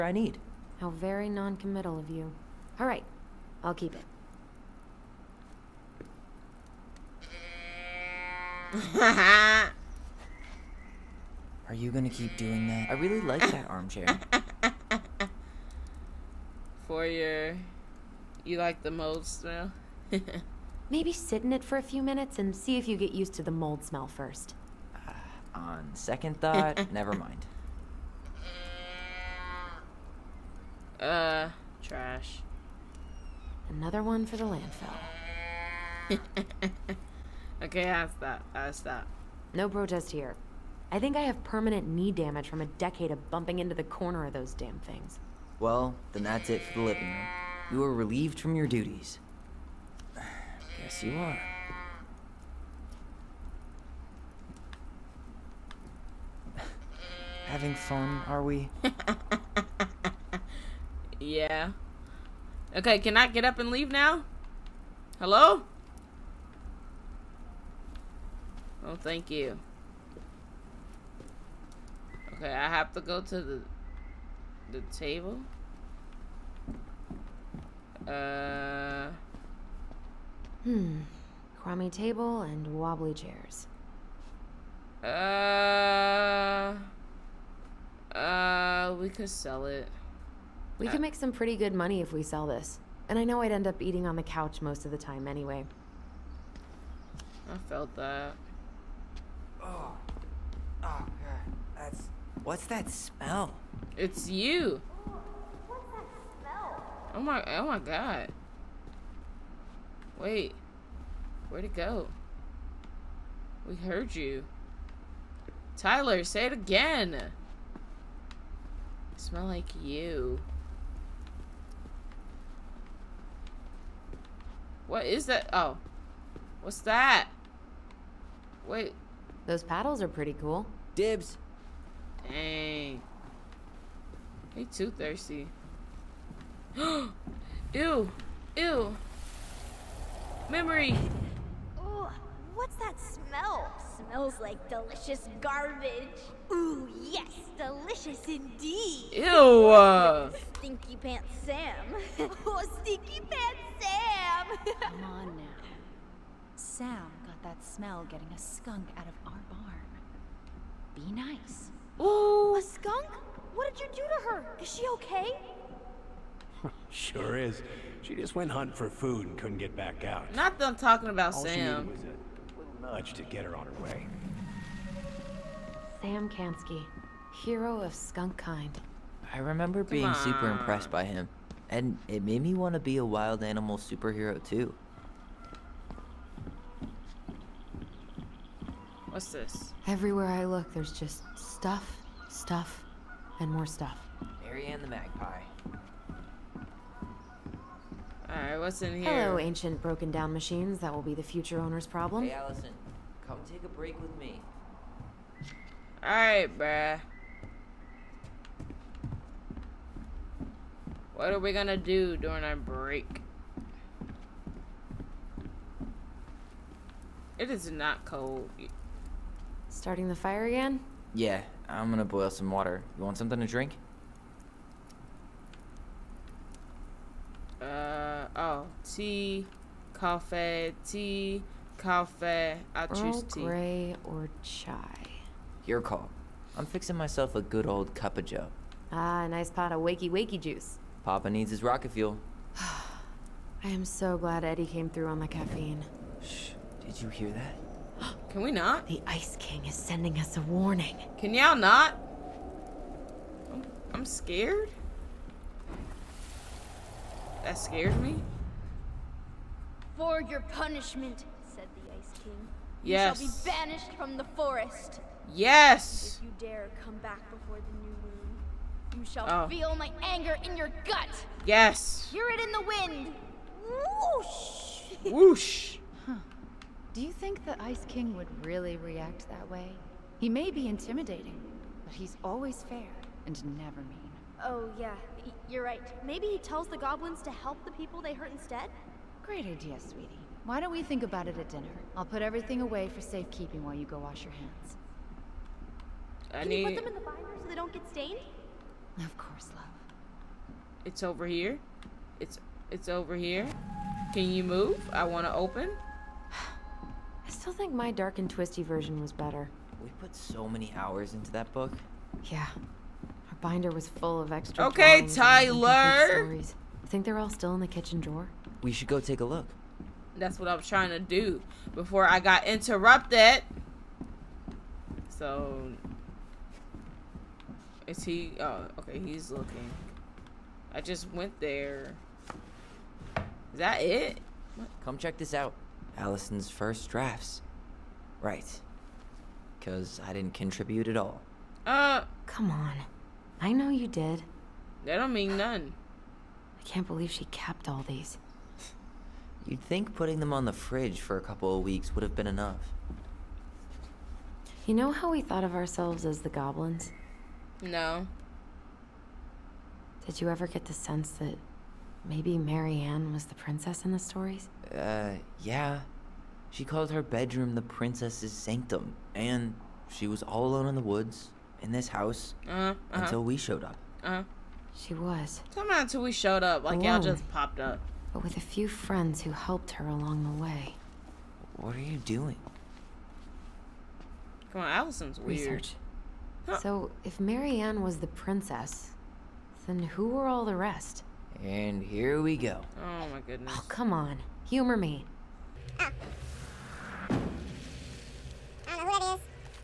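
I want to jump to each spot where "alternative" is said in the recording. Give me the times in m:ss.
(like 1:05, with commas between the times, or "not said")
not said.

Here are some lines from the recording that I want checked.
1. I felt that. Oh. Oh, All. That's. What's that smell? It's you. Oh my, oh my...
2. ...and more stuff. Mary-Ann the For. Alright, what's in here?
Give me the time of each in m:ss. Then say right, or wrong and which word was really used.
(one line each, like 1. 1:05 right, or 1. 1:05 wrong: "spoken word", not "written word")
1. 1:37 wrong: "God", not "All"
2. 3:13 wrong: "Magpie", not "For".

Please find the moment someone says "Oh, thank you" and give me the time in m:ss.
1:08.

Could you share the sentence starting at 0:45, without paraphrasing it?
Well, then that's it for the living room.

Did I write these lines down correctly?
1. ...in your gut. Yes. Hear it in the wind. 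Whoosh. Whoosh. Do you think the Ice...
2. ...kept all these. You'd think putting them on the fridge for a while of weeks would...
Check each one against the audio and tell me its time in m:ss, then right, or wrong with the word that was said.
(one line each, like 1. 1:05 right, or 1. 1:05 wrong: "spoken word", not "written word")
1. 4:30 right
2. 5:47 wrong: "couple", not "while".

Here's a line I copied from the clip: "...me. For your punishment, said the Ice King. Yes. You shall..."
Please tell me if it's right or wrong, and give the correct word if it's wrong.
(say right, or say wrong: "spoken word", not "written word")
right.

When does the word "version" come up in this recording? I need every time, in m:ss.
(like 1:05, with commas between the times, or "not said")
5:08.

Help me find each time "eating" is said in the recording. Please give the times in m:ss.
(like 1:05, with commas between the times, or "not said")
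1:33.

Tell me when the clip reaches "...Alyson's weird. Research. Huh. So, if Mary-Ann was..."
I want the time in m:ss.
6:24.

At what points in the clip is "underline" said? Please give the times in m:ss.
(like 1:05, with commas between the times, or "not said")
not said.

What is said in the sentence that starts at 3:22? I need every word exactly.
Hey, Alyson, come take a break with me.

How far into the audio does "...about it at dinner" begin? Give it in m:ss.
4:51.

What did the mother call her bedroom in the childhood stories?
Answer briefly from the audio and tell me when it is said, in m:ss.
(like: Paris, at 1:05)
The princess's sanctum, at 6:07.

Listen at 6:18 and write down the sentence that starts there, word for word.
But with a few friends who helped her along the way.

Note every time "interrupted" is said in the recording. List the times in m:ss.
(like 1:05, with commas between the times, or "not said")
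5:22.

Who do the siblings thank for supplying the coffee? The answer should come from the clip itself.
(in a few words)
Eddie.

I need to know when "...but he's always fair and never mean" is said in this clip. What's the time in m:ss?
4:41.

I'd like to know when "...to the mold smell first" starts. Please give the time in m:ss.
0:23.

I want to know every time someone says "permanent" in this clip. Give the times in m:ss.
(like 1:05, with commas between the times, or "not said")
0:41.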